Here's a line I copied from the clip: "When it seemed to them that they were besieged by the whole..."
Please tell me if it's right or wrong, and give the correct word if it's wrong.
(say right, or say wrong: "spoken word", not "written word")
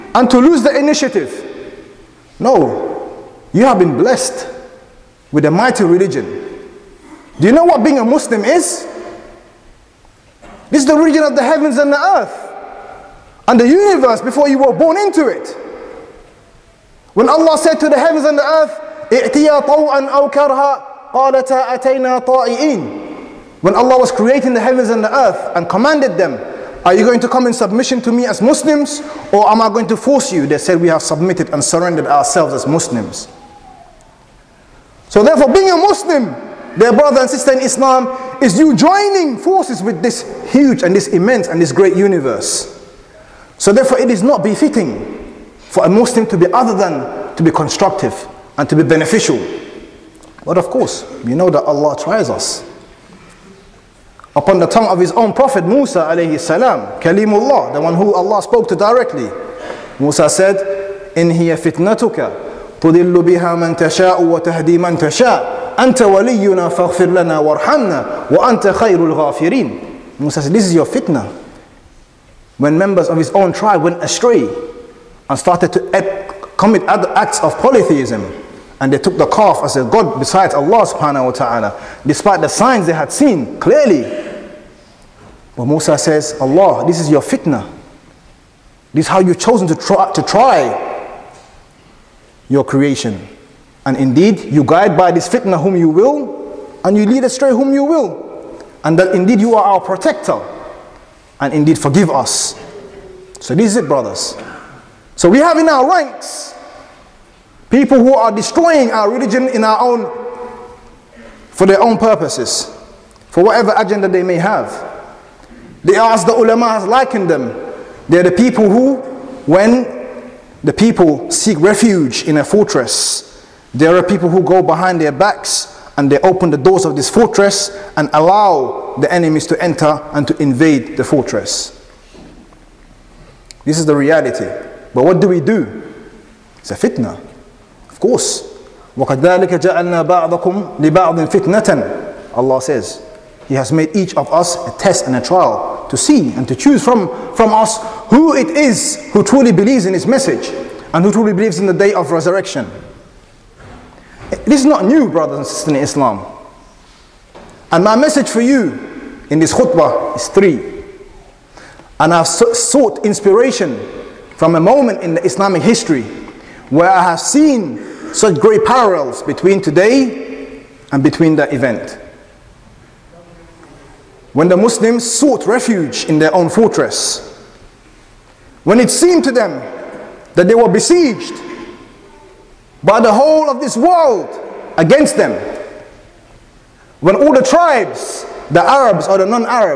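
right.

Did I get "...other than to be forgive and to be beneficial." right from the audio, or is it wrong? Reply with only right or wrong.
wrong.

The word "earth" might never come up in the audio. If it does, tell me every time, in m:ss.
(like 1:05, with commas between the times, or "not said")
0:11, 0:18, 0:25.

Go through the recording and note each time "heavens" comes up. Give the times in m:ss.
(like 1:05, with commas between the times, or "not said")
0:11, 0:17, 0:24.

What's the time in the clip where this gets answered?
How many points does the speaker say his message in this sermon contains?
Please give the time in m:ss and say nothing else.
2:40.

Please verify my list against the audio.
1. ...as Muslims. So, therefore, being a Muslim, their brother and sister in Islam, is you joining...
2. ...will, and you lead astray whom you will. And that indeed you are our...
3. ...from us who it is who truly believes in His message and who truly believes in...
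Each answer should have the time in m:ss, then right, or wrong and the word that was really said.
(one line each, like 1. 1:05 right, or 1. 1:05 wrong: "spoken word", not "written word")
1. 0:32 right
2. 1:35 right
3. 2:27 right.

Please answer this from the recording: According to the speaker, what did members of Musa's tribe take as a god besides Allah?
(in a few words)
The calf.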